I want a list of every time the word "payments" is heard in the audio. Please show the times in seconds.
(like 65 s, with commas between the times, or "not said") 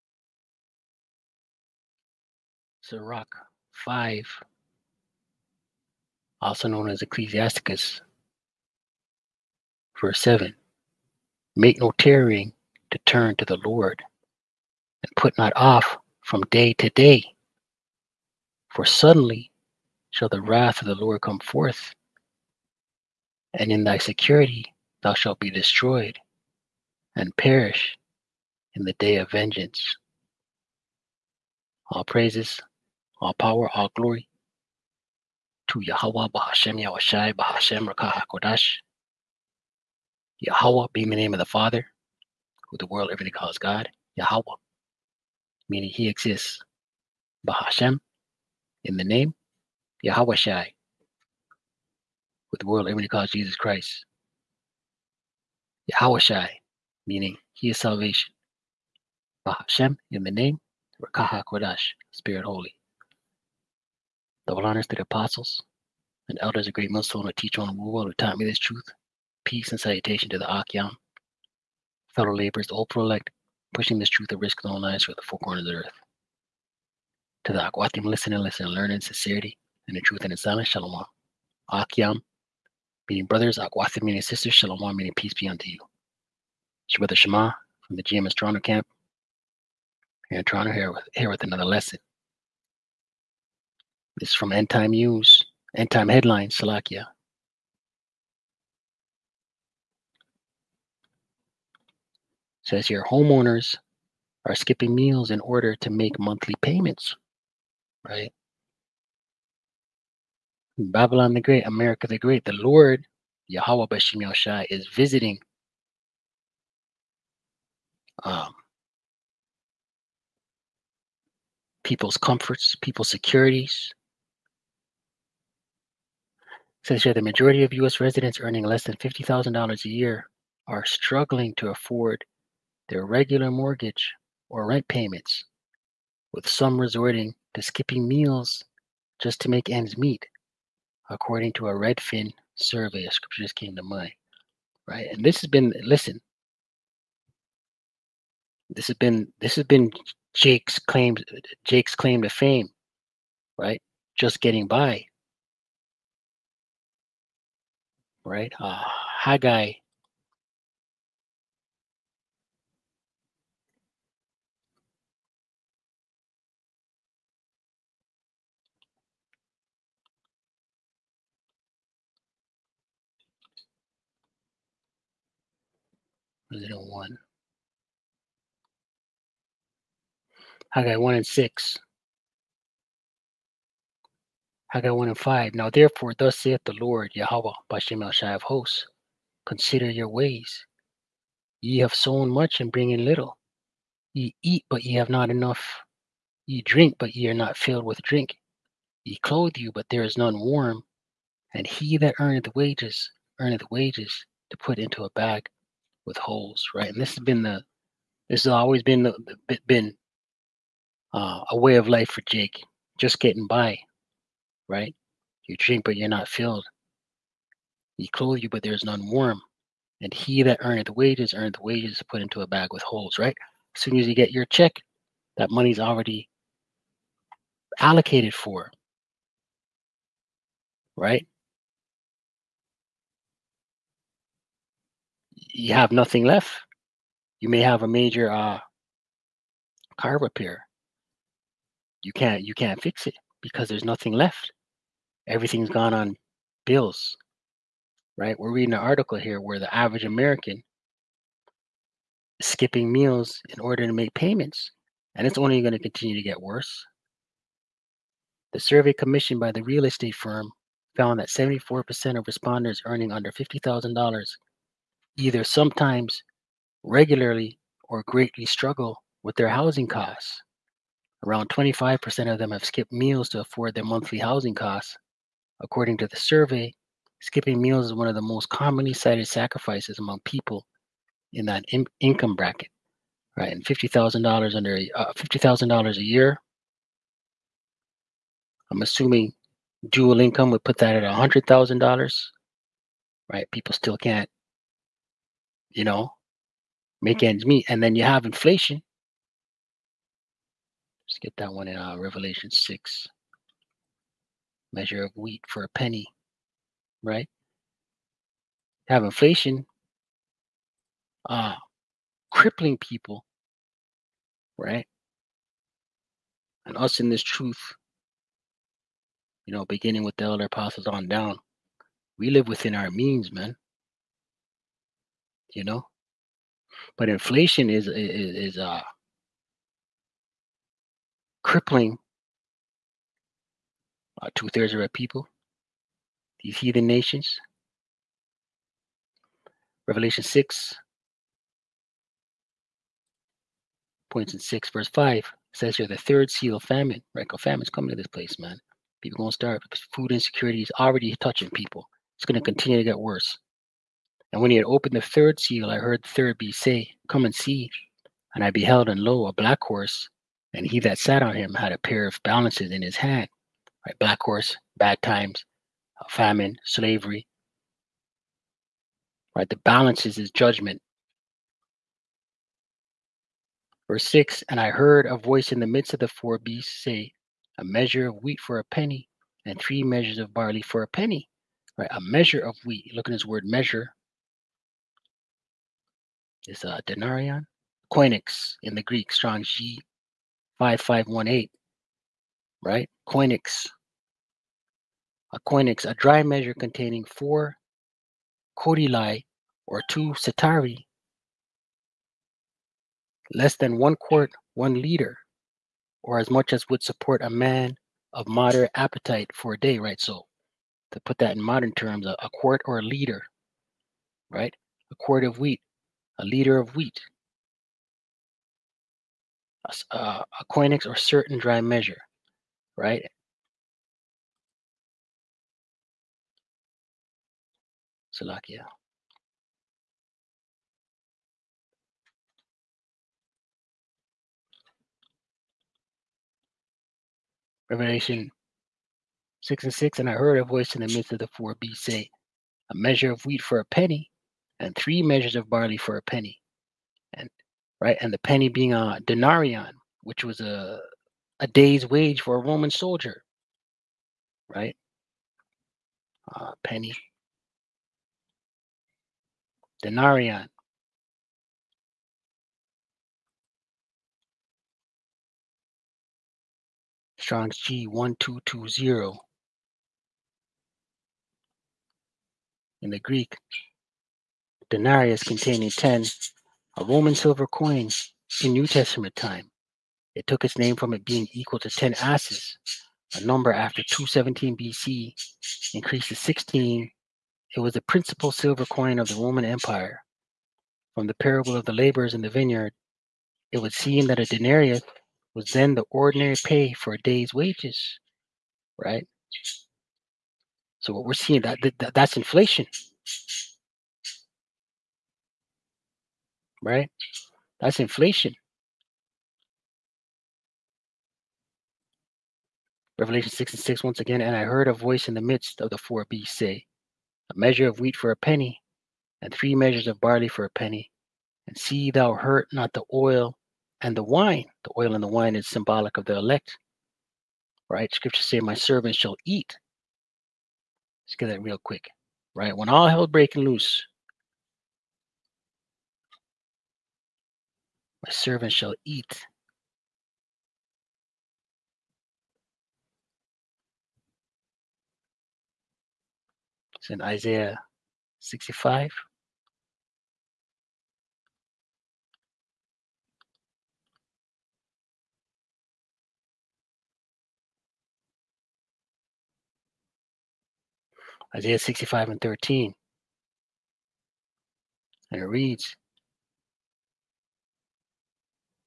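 106 s, 134 s, 254 s.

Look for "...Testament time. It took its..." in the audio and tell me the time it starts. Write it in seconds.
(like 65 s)
478 s.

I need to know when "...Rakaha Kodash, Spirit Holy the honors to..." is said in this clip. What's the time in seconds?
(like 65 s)
61 s.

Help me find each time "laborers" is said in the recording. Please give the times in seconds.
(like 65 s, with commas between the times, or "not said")
72 s, 491 s.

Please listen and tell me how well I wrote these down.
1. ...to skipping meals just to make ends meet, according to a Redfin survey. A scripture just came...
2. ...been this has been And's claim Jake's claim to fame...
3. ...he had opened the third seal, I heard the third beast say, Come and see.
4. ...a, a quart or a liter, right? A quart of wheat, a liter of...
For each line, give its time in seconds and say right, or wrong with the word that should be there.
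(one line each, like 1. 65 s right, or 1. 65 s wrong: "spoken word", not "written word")
1. 137 s right
2. 148 s wrong: "Jake", not "And"
3. 354 s right
4. 412 s right.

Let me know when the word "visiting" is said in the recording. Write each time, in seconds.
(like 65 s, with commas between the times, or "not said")
114 s.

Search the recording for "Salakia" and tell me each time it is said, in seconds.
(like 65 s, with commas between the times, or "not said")
96 s, 428 s.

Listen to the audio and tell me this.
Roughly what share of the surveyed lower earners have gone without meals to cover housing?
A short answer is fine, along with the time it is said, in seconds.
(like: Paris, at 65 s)
25%, at 271 s.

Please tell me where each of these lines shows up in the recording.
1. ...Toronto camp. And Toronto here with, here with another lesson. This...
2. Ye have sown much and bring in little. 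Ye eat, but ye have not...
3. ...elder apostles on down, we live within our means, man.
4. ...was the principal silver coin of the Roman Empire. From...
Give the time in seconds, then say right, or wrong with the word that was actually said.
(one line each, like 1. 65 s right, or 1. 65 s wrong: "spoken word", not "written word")
1. 88 s right
2. 191 s right
3. 320 s right
4. 487 s right.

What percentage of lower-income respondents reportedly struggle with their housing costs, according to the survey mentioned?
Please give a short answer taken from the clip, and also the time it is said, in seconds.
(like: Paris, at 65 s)
74%, at 261 s.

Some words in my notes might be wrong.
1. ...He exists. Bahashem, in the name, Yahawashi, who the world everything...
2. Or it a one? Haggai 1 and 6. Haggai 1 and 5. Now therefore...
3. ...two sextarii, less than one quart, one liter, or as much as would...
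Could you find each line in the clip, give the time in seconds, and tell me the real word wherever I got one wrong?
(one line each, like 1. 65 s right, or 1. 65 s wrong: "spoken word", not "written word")
1. 45 s right
2. 176 s right
3. 399 s right.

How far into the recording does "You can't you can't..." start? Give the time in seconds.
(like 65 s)
242 s.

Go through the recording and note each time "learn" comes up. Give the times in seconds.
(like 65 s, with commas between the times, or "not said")
78 s.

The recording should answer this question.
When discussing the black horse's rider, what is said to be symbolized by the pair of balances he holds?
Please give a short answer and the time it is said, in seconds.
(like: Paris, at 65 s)
his judgment, at 370 s.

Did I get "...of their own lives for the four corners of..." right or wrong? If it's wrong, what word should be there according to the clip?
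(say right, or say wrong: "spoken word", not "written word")
right.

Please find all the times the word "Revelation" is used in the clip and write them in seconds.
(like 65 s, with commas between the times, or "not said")
301 s, 339 s, 437 s, 512 s.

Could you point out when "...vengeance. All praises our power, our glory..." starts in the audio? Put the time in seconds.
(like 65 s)
29 s.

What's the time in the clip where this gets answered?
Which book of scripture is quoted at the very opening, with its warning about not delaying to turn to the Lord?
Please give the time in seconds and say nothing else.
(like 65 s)
2 s.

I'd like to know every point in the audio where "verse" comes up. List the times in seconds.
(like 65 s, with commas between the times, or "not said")
9 s, 344 s, 373 s.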